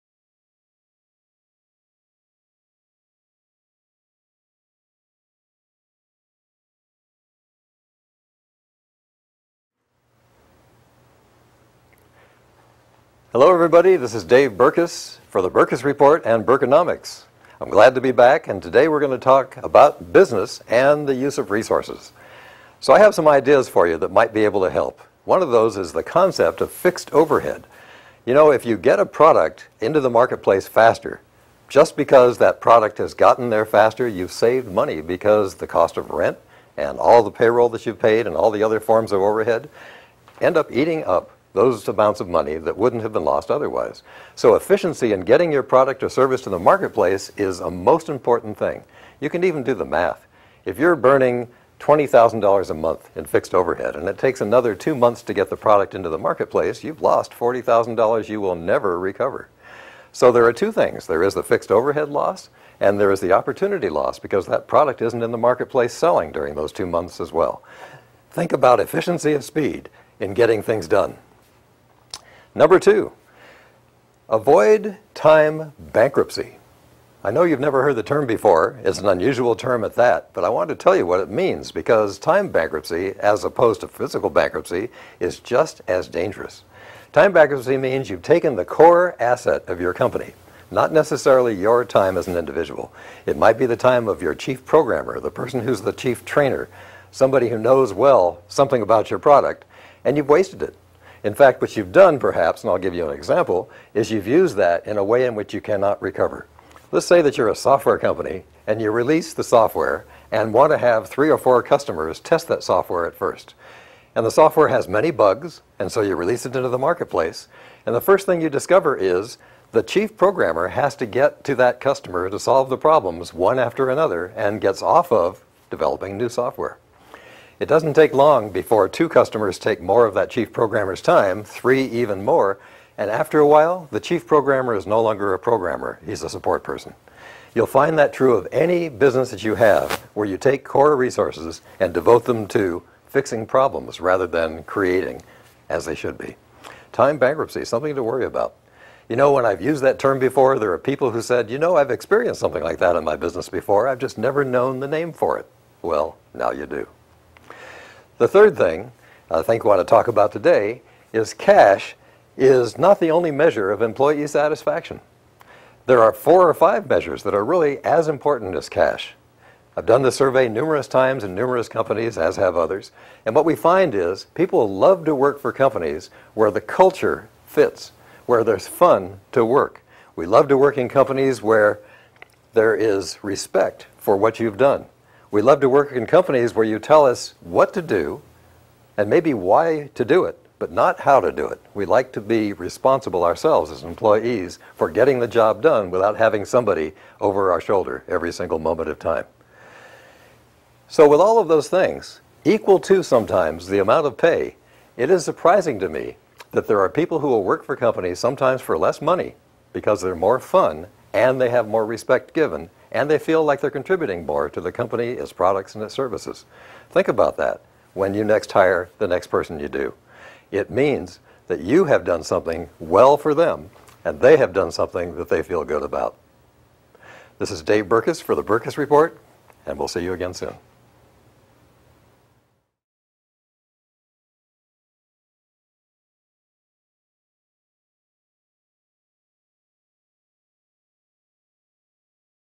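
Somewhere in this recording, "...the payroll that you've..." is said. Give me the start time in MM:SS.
00:37.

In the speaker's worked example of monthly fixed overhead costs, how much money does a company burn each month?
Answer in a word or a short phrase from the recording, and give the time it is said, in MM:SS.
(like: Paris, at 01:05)
$20,000, at 00:51.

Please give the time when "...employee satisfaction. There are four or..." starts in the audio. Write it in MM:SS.
02:43.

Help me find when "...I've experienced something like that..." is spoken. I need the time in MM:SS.
02:31.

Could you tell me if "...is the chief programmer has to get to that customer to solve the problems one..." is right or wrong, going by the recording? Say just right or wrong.
right.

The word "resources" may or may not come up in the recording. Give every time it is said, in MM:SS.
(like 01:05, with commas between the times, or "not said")
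00:21, 02:20.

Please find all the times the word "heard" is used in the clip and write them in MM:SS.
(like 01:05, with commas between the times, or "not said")
01:17.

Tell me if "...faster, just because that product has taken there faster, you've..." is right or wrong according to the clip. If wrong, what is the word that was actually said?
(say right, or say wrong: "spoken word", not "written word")
wrong: "gotten", not "taken".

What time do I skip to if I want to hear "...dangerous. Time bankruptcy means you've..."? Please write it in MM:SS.
01:26.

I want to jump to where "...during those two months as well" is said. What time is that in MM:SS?
01:06.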